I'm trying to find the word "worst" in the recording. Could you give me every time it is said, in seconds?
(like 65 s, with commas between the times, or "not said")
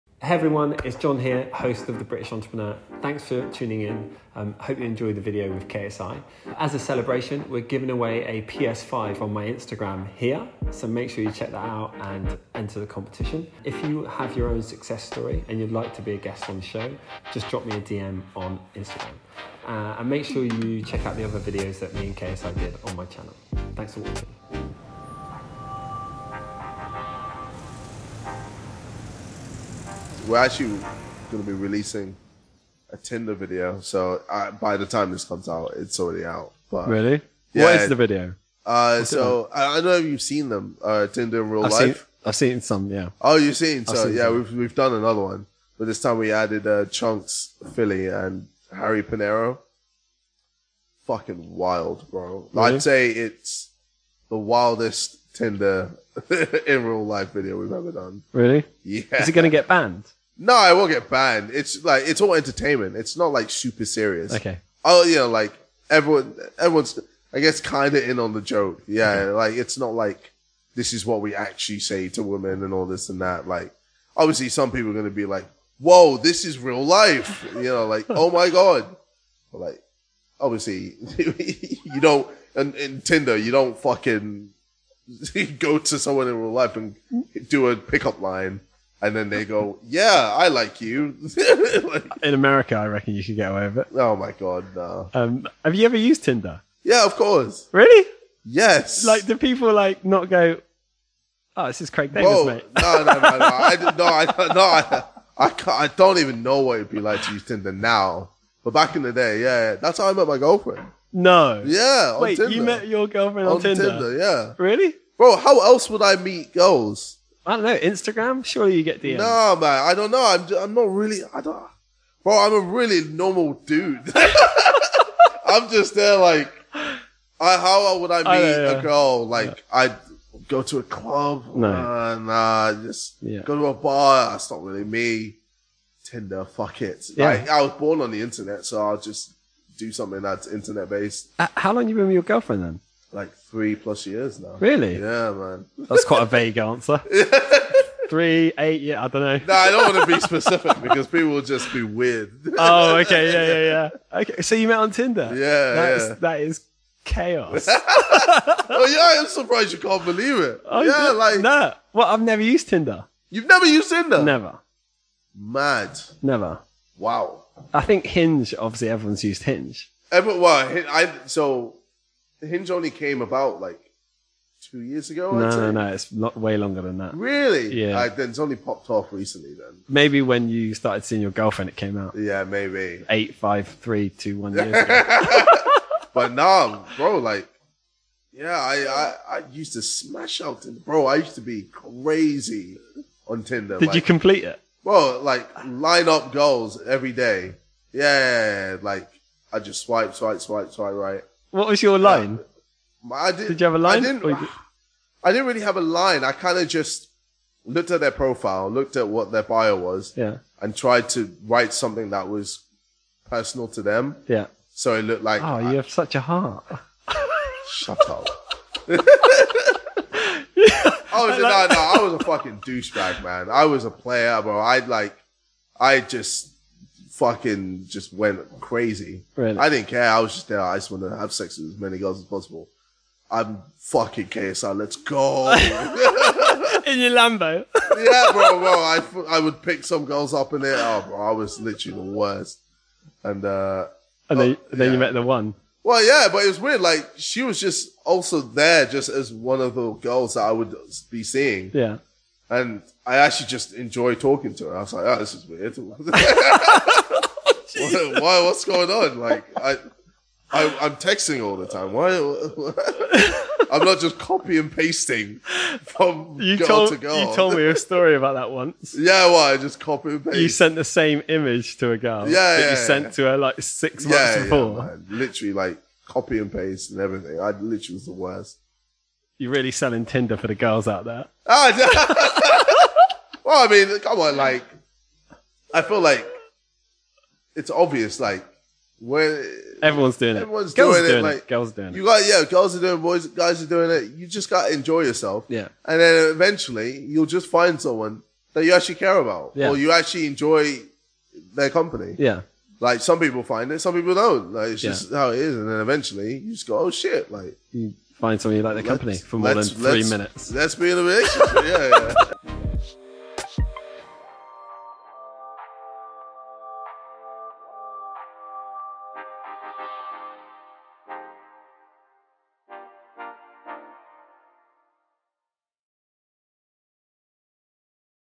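242 s, 278 s.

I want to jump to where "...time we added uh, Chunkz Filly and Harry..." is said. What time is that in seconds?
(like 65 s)
46 s.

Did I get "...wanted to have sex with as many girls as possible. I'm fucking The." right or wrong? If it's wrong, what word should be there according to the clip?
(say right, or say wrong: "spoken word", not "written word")
wrong: "KSI", not "The".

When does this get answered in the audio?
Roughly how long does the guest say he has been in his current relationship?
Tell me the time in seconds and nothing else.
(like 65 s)
143 s.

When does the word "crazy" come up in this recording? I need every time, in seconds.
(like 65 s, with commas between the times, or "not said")
191 s, 228 s.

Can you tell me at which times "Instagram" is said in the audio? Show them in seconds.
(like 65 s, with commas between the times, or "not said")
9 s, 18 s, 117 s.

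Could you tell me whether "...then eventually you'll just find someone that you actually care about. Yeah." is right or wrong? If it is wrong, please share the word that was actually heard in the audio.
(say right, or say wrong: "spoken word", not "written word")
right.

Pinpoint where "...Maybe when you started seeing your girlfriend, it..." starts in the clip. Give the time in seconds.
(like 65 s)
179 s.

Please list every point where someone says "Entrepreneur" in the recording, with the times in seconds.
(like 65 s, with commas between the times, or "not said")
2 s.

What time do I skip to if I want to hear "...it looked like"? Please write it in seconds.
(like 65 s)
214 s.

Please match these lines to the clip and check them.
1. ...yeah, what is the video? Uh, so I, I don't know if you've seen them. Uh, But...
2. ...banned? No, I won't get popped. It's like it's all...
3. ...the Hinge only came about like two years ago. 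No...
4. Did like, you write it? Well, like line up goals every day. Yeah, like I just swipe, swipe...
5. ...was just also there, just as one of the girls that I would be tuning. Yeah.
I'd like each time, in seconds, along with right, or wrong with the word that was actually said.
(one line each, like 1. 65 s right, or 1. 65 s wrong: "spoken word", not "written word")
1. 37 s wrong: "Tinder", not "But"
2. 59 s wrong: "banned", not "popped"
3. 172 s right
4. 193 s wrong: "complete", not "write"
5. 247 s wrong: "seeing", not "tuning".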